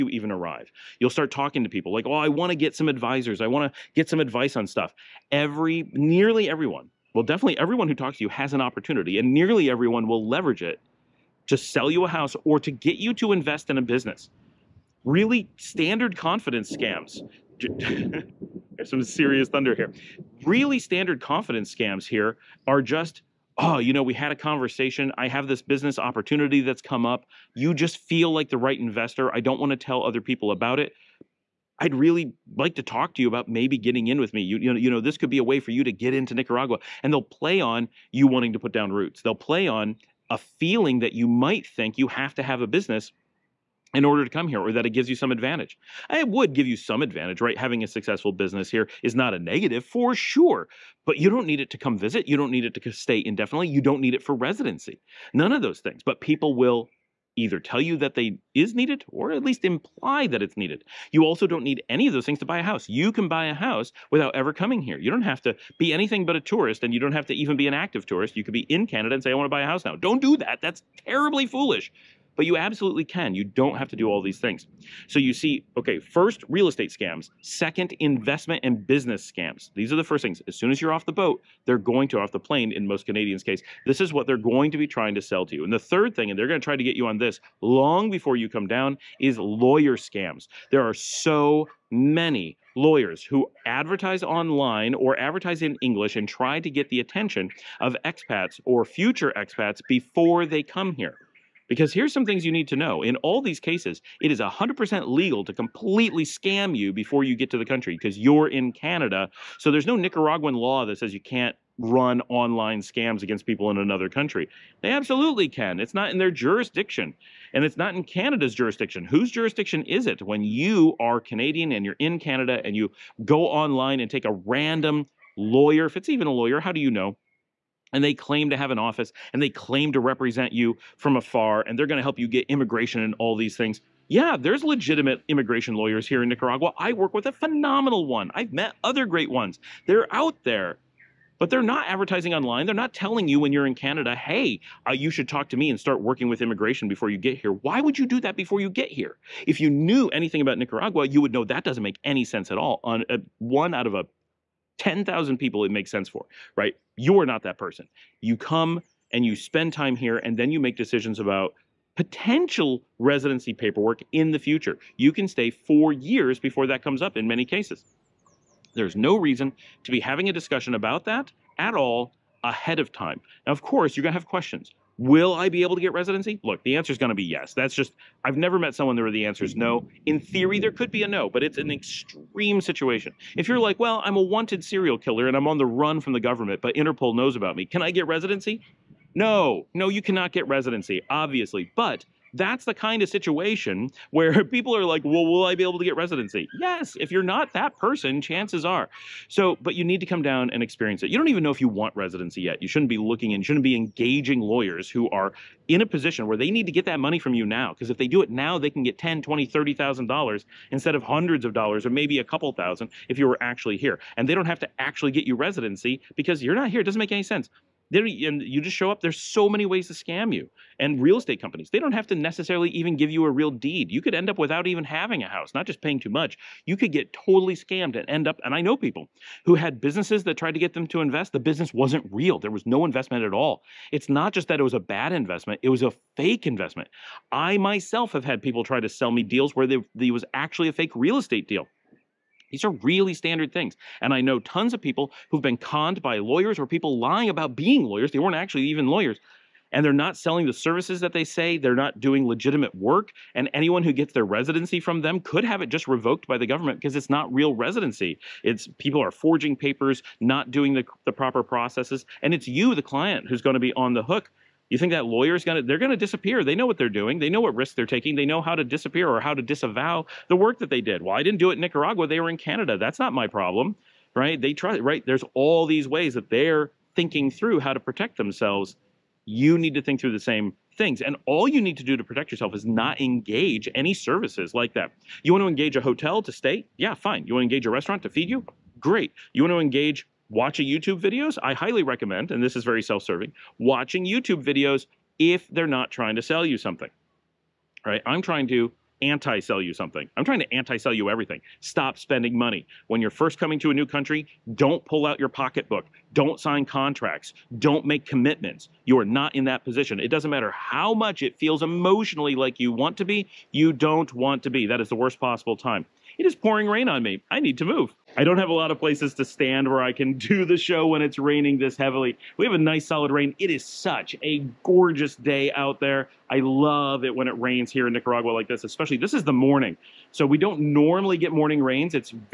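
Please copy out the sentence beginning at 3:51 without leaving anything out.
The business wasn't real, there was no investment at all.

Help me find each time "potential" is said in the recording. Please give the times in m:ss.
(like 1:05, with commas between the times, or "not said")
2:41.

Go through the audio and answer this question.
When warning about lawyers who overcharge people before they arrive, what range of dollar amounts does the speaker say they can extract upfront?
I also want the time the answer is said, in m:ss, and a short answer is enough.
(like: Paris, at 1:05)
10, 20, 30,000 dollars, at 3:28.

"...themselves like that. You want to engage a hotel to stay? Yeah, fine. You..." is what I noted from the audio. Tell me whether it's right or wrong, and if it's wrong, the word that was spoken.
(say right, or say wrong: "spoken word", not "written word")
wrong: "services", not "themselves".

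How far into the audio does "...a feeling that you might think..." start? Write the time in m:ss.
0:40.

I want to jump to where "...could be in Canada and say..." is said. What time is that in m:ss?
1:08.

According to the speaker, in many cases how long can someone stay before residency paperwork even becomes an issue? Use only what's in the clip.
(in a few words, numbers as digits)
4 years.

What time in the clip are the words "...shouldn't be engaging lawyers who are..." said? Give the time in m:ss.
3:23.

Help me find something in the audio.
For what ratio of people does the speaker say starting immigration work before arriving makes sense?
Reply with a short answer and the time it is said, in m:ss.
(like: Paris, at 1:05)
1 out of 10,000, at 2:33.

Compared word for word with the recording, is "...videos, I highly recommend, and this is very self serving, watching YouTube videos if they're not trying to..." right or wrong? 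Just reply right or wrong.
right.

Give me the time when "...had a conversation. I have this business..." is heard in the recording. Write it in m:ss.
0:24.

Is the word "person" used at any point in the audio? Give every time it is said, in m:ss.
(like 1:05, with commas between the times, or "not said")
2:37, 3:17.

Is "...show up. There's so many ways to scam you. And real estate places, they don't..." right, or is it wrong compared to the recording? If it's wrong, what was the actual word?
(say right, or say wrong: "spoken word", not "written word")
wrong: "companies", not "places".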